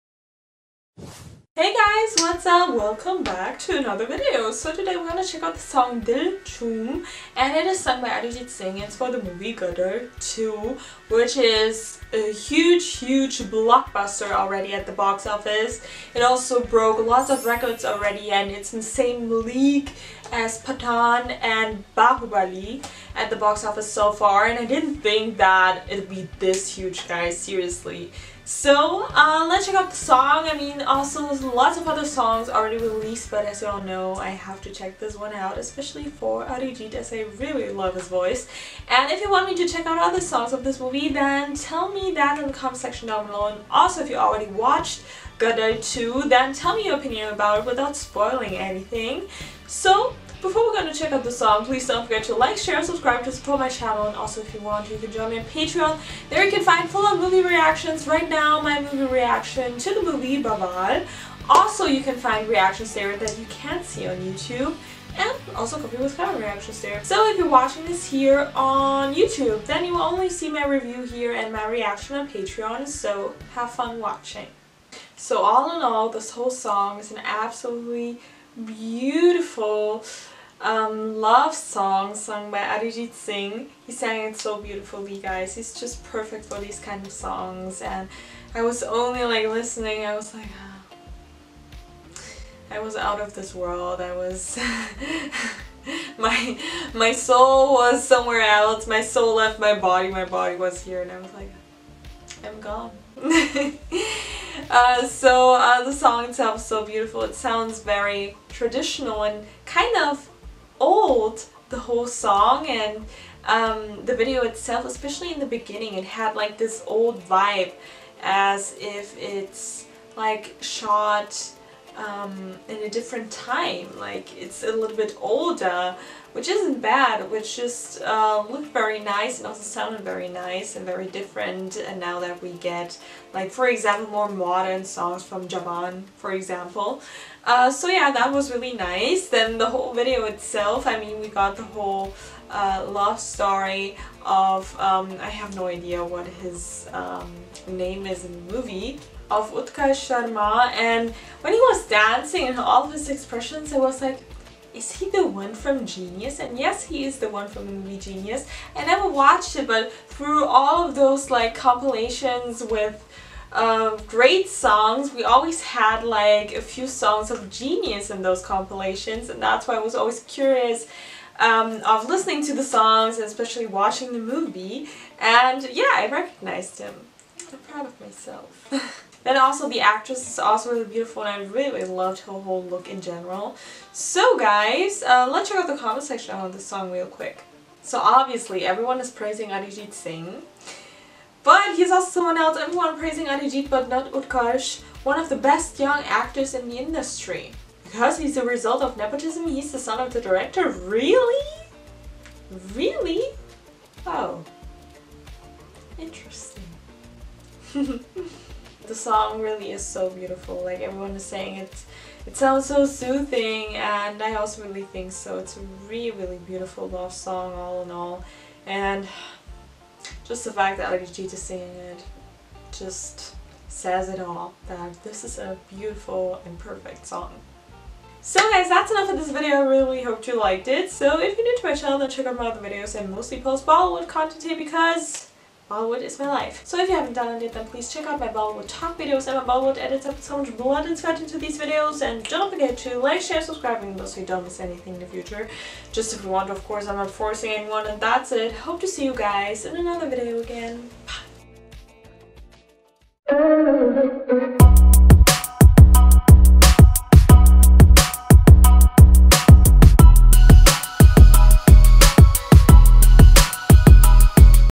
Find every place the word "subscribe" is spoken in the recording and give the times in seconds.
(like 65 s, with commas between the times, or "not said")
52 s, 243 s.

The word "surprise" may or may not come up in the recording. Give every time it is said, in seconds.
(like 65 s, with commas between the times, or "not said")
not said.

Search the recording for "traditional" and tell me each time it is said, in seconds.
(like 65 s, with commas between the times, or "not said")
108 s.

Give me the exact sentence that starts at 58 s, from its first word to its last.
Right now, my movie reaction to the movie Baban.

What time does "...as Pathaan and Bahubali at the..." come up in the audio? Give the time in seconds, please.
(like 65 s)
20 s.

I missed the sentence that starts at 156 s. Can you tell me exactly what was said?
And yes, he is the one from the movie Genius.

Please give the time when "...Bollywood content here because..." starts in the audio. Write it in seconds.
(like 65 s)
233 s.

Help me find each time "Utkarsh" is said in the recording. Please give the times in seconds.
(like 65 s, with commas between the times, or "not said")
149 s, 194 s.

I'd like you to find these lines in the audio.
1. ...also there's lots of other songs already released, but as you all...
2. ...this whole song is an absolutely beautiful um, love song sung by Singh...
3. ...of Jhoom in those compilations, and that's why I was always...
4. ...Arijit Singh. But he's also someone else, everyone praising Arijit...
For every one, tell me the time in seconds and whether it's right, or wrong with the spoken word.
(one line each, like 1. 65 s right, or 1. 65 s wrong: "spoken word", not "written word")
1. 30 s right
2. 76 s wrong: "Arijit", not "Singh"
3. 167 s wrong: "Genius", not "Jhoom"
4. 189 s right.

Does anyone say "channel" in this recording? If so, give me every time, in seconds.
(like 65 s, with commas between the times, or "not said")
53 s, 231 s.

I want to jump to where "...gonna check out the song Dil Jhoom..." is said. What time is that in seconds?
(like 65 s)
5 s.